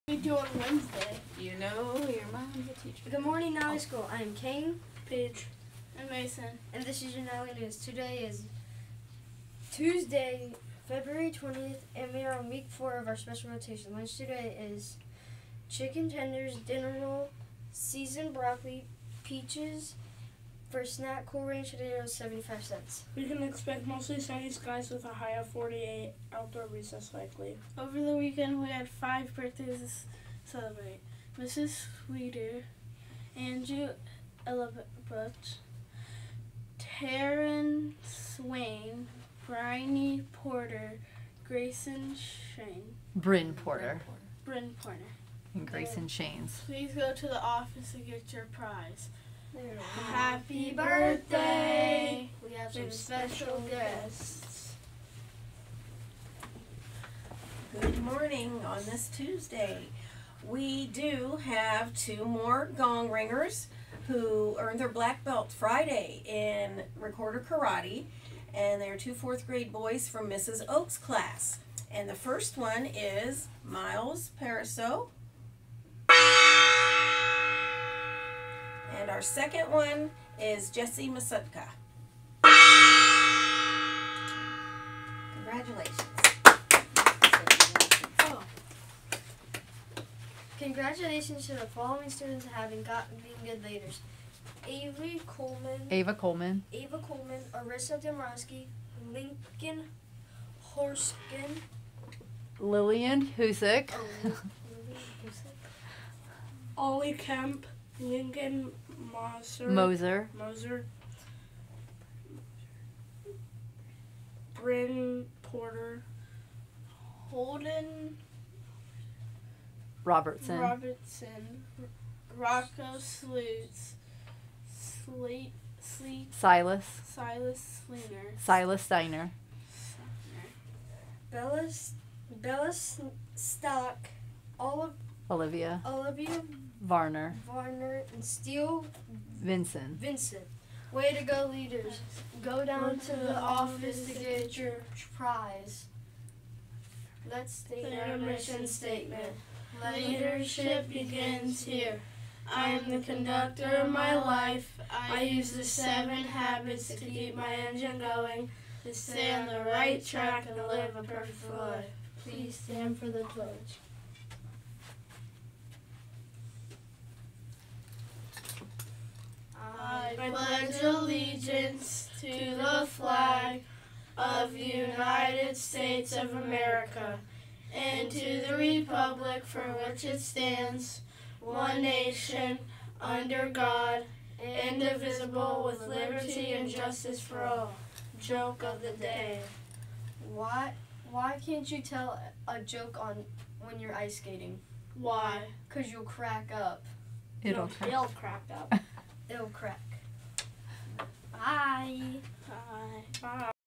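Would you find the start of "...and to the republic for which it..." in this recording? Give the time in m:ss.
2:57.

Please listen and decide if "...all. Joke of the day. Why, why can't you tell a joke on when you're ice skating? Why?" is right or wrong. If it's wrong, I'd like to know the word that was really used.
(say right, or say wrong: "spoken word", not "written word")
right.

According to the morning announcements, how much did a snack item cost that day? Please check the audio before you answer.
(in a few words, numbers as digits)
75 cents.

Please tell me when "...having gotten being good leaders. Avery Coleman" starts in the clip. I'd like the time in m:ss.
1:32.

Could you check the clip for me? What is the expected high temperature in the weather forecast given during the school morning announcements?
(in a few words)
48.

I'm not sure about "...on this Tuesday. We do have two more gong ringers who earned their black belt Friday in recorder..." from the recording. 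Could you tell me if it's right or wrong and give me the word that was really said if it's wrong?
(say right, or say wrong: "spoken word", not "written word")
right.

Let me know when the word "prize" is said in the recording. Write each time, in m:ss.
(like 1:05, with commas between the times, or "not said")
0:48, 2:25.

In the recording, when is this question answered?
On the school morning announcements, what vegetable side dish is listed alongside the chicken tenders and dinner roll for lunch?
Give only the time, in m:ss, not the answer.
0:17.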